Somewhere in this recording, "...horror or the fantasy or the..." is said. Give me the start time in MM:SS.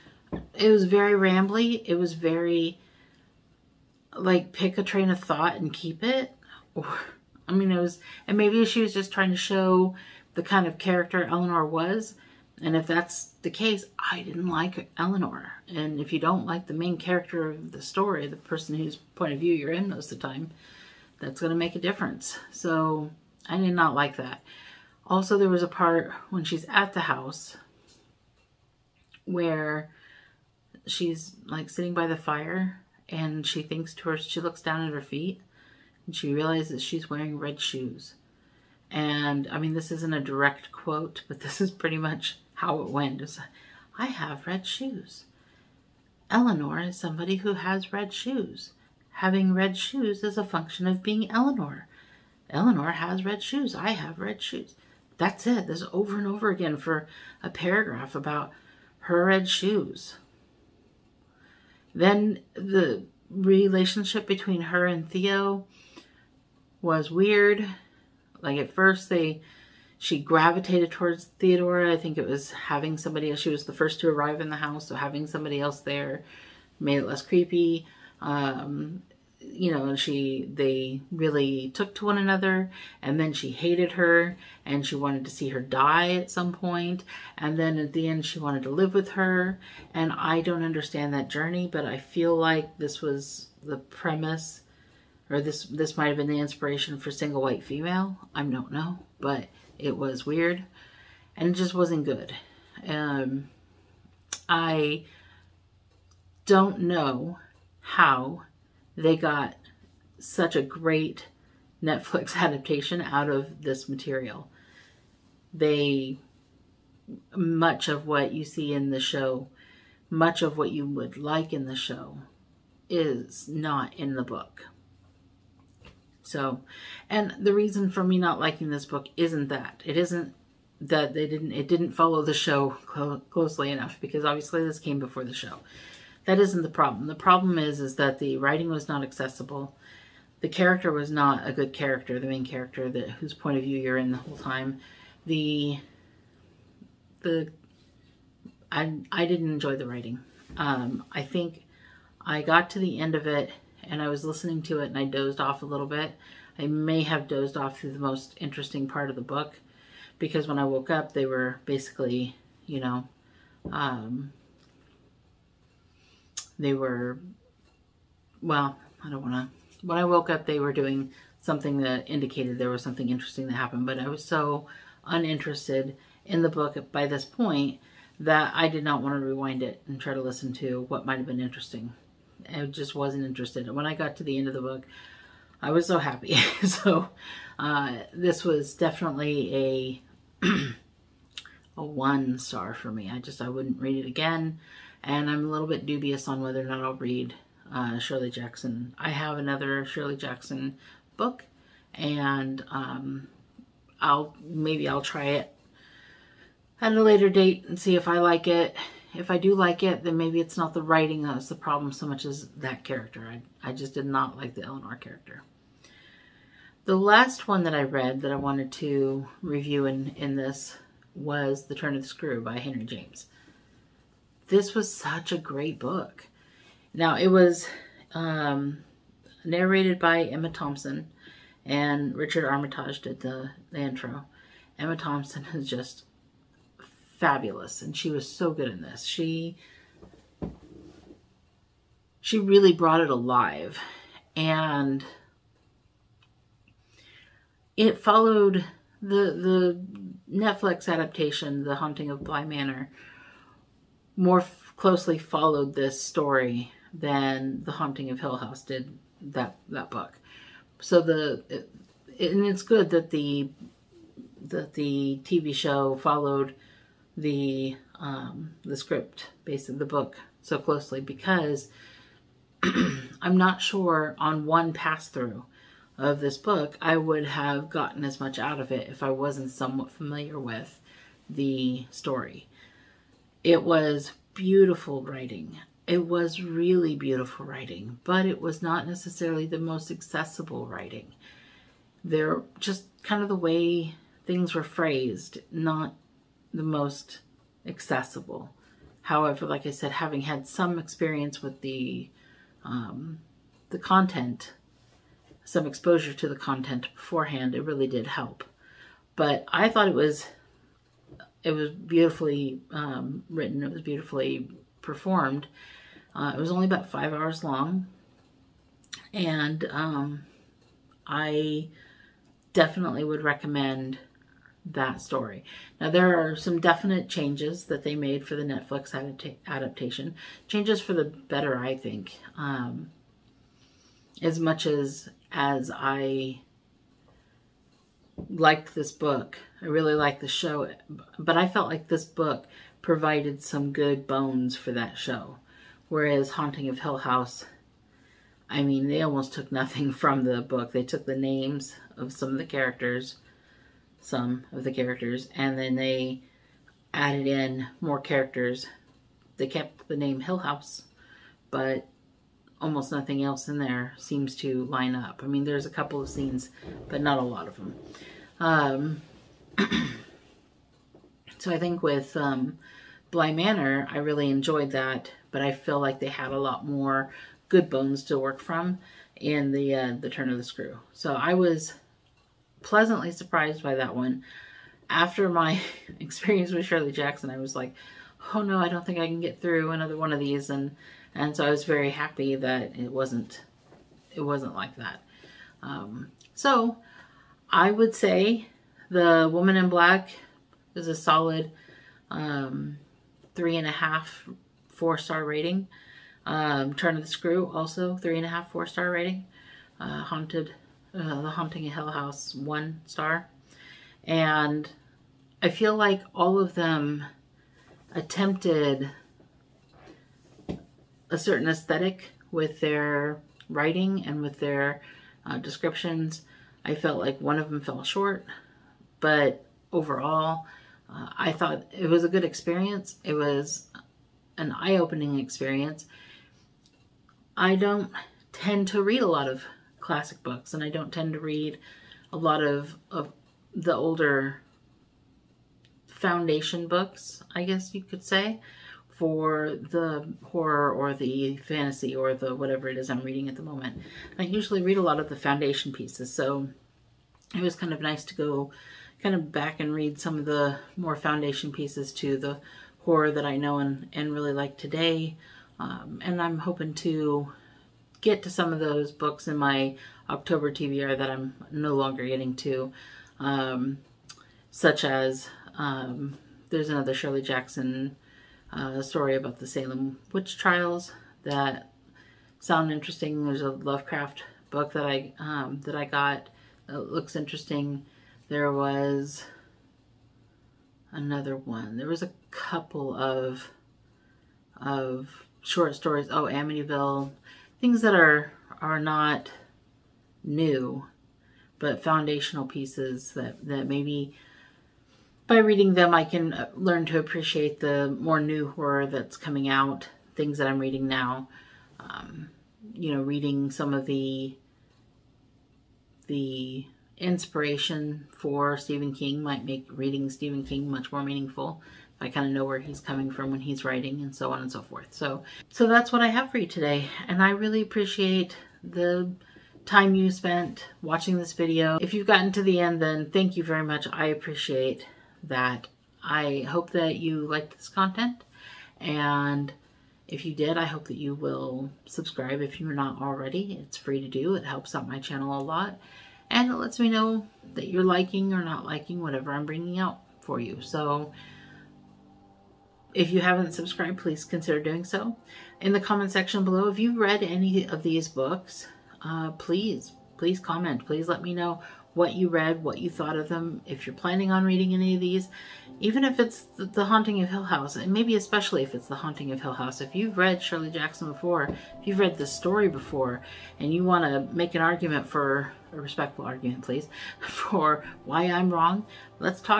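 07:30.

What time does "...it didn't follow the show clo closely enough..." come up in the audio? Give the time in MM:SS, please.
02:11.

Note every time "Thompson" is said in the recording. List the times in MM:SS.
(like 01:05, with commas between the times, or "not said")
03:50, 03:54.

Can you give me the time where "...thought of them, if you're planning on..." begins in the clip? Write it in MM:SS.
09:22.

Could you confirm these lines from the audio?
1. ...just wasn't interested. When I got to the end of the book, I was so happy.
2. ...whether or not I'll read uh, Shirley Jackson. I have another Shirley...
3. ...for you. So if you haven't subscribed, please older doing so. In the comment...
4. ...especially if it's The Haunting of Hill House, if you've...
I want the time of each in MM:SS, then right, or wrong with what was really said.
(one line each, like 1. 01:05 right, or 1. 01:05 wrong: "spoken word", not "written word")
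1. 03:02 right
2. 03:16 right
3. 09:10 wrong: "consider", not "older"
4. 09:28 right.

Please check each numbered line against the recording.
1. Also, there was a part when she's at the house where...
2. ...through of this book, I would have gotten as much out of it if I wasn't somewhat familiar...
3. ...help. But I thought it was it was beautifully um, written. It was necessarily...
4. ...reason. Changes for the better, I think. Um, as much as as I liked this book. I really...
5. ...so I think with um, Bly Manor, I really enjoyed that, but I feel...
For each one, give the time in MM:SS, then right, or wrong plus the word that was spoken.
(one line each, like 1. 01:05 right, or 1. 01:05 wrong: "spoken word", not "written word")
1. 00:25 right
2. 04:35 right
3. 05:08 wrong: "beautifully", not "necessarily"
4. 05:29 wrong: "adaptation", not "reason"
5. 06:11 right.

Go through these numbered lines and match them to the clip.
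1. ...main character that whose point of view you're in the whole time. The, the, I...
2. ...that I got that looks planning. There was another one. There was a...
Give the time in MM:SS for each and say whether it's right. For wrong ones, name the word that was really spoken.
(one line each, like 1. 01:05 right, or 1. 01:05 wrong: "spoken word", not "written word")
1. 02:22 right
2. 08:05 wrong: "interesting", not "planning".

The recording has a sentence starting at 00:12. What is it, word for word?
And if that's the case, I didn't like Eleanor.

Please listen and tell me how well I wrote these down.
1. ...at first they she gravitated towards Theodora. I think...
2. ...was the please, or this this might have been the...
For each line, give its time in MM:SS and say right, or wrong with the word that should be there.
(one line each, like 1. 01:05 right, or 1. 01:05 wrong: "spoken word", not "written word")
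1. 01:08 right
2. 01:33 wrong: "premise", not "please".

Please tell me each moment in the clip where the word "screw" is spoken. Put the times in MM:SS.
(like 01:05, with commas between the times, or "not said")
03:42, 06:20, 06:47.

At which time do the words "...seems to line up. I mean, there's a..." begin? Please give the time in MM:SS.
06:03.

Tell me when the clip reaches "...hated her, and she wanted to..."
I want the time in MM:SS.
01:23.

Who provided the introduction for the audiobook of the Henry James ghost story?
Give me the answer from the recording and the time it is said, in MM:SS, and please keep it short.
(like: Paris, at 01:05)
Richard Armitage, at 03:52.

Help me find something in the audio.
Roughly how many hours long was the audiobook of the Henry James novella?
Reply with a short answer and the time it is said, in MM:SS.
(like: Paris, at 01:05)
5, at 05:16.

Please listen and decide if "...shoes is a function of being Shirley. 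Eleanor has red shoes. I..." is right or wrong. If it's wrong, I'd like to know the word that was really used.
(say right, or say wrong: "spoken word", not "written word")
wrong: "Eleanor", not "Shirley".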